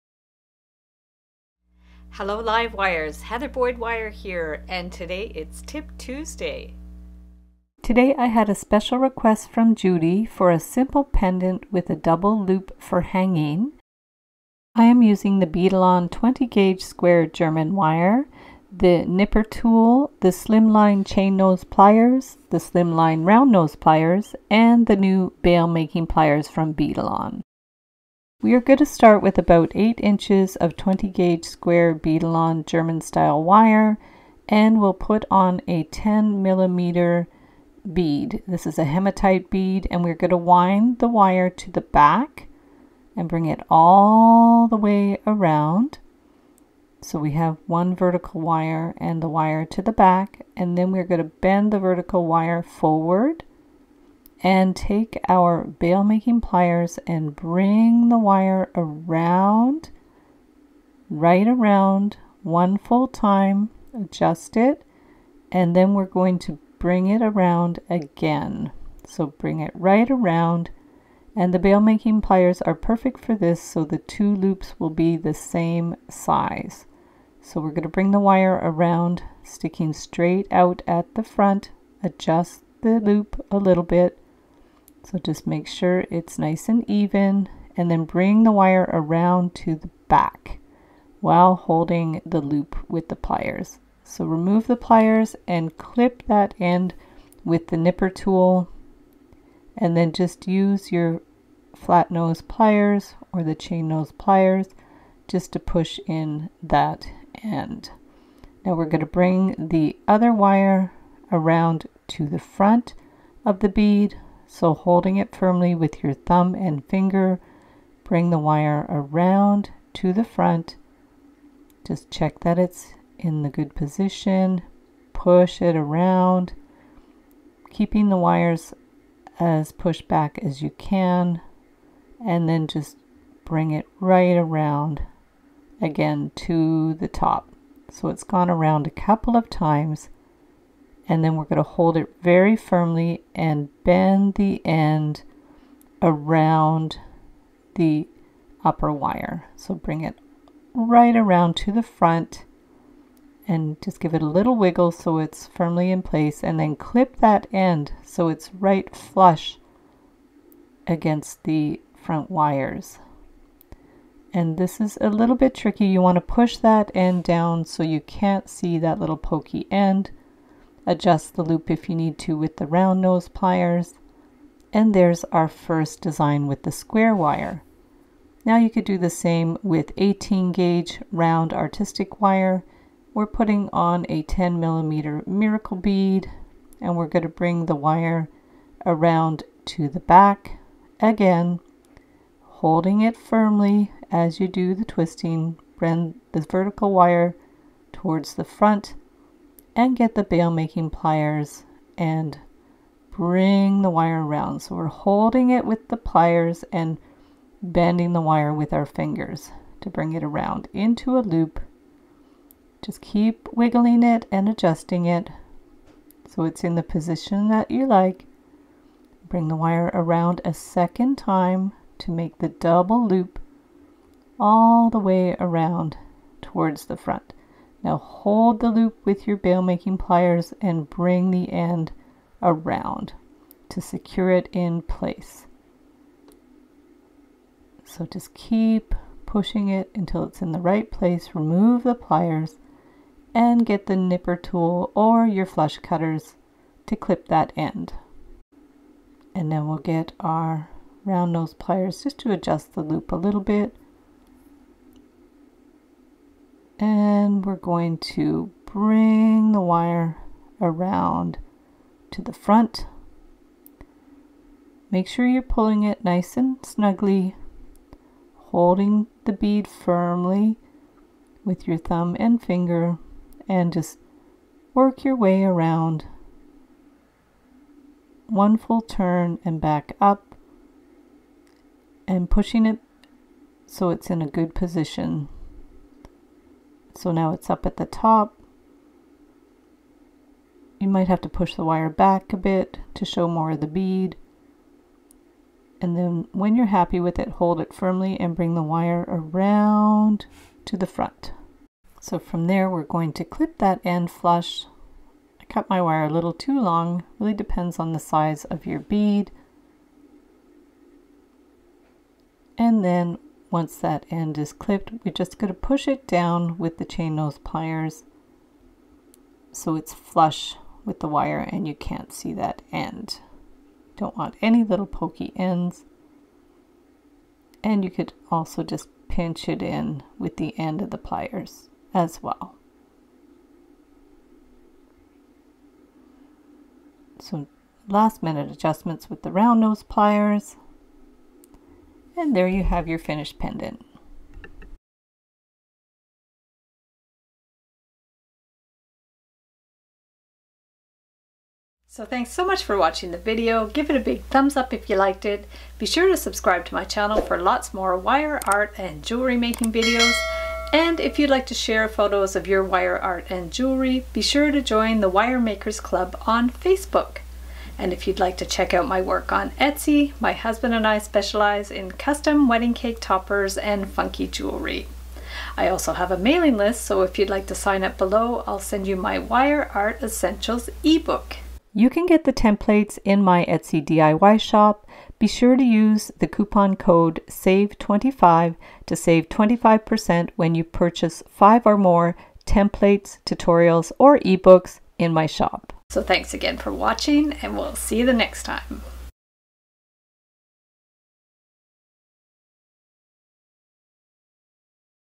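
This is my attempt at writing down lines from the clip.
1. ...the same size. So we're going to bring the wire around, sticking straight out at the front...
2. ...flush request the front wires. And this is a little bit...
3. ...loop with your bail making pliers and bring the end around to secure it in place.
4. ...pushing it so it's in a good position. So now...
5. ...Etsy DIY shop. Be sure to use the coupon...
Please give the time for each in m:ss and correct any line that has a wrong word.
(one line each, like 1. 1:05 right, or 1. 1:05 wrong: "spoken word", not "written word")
1. 1:15 right
2. 2:38 wrong: "against", not "request"
3. 3:48 right
4. 4:42 right
5. 6:23 right.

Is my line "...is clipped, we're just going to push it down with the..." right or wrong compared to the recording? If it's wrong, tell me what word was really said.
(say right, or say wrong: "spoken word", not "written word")
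right.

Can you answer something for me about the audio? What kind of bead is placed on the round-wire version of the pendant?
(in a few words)
miracle bead.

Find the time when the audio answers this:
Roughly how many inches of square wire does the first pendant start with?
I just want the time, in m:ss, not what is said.
0:29.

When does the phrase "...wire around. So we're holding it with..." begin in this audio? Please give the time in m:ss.
3:23.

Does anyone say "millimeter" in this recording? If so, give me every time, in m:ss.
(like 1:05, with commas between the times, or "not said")
0:36, 3:04.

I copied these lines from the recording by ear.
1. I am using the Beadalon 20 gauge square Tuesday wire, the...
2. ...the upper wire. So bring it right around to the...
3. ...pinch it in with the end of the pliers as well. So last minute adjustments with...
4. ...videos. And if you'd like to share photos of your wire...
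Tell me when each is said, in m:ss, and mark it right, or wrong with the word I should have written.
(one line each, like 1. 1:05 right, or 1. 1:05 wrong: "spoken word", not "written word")
1. 0:14 wrong: "German", not "Tuesday"
2. 2:27 right
3. 5:29 right
4. 5:59 right.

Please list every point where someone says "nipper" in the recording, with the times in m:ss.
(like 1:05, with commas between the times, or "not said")
0:19, 1:37, 4:03.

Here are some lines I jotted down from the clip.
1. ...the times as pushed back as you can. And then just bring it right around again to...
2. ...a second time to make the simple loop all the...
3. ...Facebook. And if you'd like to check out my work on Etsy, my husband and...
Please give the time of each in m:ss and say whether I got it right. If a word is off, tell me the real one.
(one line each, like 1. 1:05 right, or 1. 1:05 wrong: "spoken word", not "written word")
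1. 2:08 wrong: "wires", not "times"
2. 3:40 wrong: "double", not "simple"
3. 6:06 right.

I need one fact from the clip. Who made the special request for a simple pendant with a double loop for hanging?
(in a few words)
Judy.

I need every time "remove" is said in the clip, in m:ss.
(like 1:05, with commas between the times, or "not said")
1:34, 4:01.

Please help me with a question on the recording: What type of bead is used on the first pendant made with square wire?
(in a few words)
hematite.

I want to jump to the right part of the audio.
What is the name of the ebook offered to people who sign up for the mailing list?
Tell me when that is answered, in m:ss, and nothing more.
6:19.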